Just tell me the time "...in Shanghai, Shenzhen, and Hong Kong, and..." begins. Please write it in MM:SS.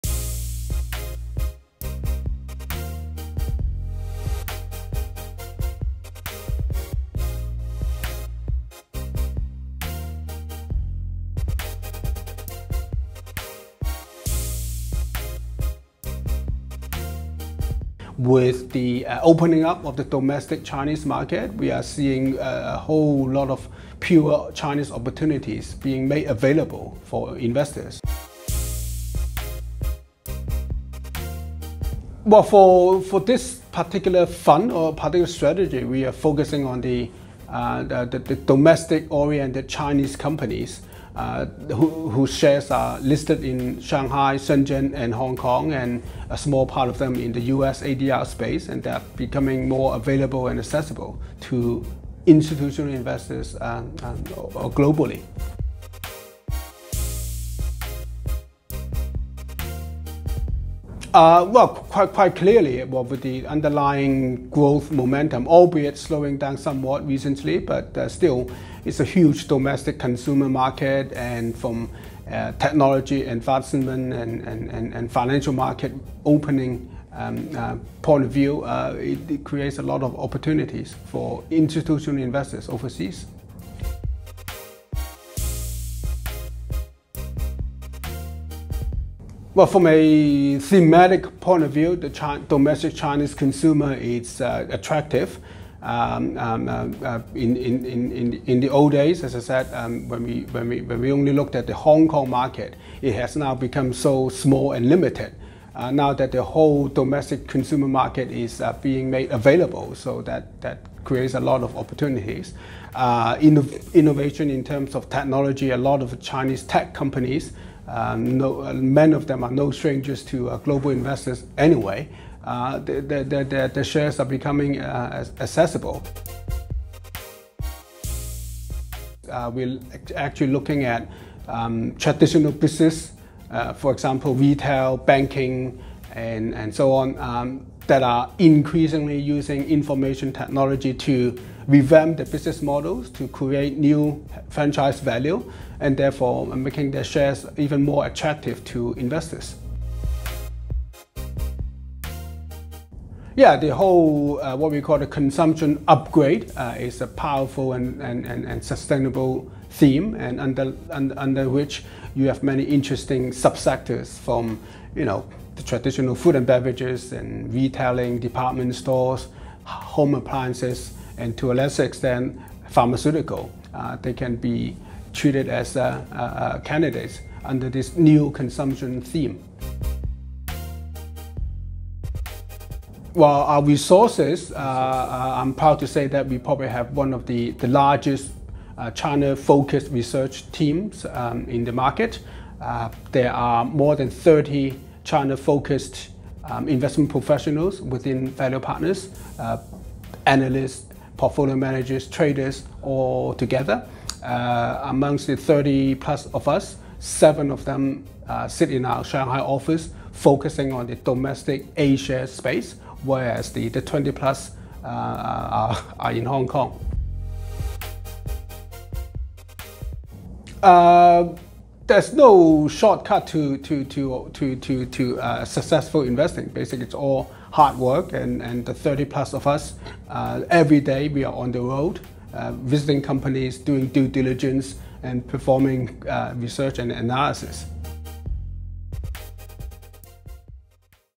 00:43.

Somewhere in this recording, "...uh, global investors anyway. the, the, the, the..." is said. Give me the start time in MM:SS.
02:00.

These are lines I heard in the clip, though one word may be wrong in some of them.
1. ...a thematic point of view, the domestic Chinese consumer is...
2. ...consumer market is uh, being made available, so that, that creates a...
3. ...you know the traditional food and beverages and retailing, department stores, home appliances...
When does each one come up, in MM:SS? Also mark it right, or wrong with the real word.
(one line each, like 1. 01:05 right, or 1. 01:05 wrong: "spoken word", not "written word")
1. 01:29 right
2. 01:47 right
3. 02:44 right.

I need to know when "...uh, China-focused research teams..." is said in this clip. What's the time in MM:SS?
03:08.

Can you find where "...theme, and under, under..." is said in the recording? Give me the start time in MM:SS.
02:39.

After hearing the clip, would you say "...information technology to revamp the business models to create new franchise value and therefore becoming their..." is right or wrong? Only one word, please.
wrong.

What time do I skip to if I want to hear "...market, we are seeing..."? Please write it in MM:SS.
00:21.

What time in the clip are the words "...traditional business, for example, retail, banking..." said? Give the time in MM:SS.
02:11.